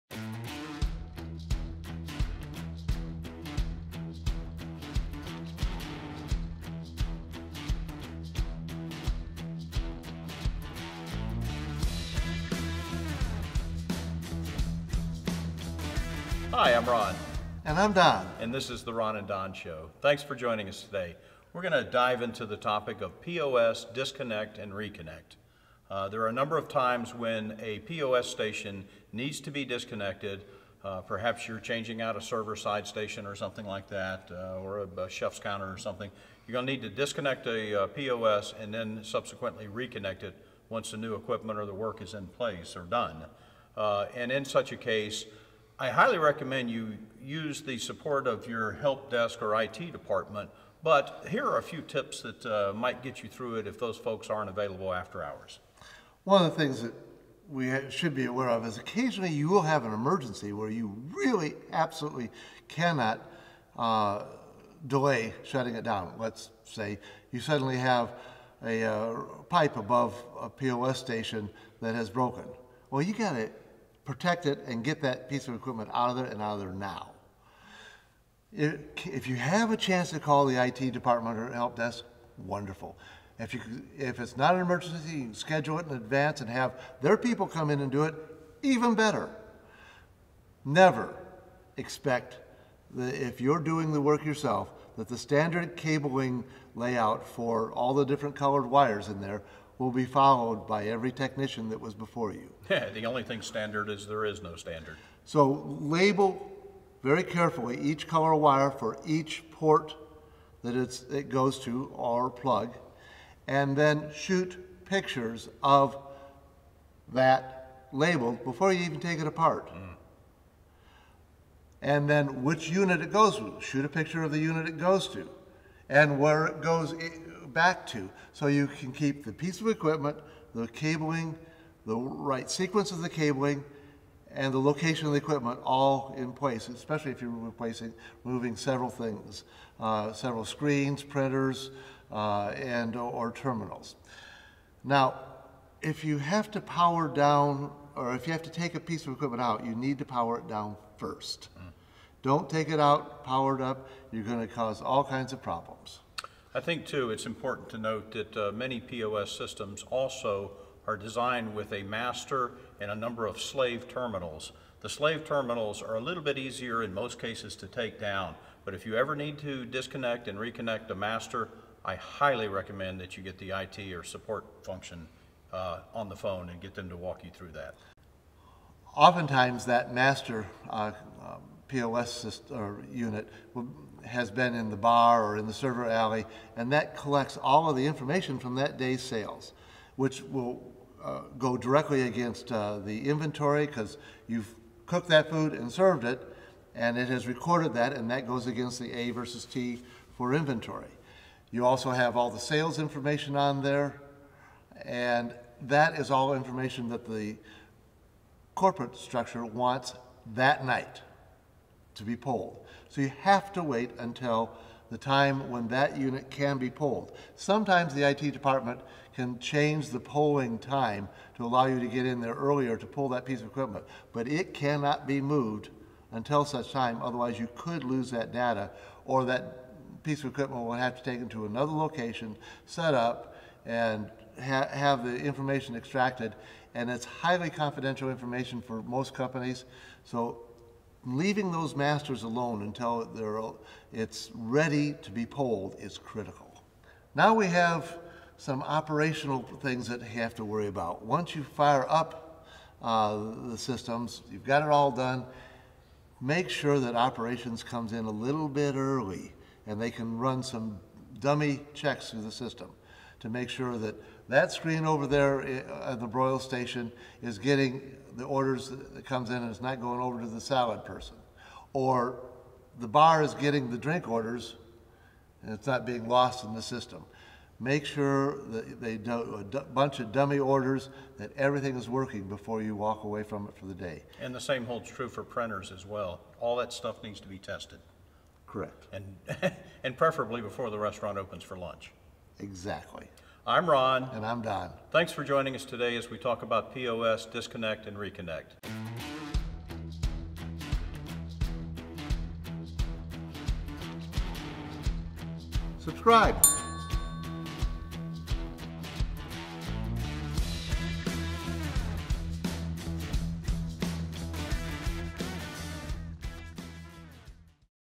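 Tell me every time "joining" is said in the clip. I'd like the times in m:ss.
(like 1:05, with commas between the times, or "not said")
0:20, 4:55.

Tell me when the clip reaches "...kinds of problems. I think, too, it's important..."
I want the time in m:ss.
2:35.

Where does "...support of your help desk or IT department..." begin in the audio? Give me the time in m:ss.
0:47.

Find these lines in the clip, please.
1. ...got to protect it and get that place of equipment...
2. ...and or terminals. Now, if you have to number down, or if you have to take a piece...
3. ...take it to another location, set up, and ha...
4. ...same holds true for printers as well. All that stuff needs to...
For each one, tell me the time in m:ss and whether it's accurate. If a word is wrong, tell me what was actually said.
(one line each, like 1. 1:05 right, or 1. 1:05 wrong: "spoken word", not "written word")
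1. 1:13 wrong: "piece", not "place"
2. 2:22 wrong: "power", not "number"
3. 3:51 right
4. 4:44 right.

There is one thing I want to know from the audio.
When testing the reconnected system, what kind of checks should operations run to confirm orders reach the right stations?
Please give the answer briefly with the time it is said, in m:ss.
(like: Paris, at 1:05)
Dummy checks, at 4:21.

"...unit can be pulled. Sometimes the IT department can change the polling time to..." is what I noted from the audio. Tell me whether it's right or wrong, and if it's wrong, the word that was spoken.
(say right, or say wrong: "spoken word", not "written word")
right.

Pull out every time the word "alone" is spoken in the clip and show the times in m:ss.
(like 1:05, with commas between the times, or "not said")
4:02.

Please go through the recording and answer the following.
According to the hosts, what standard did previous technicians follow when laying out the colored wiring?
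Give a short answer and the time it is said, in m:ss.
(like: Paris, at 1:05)
There is no standard, at 1:44.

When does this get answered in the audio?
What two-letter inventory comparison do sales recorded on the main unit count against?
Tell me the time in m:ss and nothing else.
3:18.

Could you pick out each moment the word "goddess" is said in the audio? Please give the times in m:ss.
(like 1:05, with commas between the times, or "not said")
not said.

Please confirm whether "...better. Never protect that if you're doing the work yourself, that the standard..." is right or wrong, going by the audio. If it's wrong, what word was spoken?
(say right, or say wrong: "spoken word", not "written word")
wrong: "expect", not "protect".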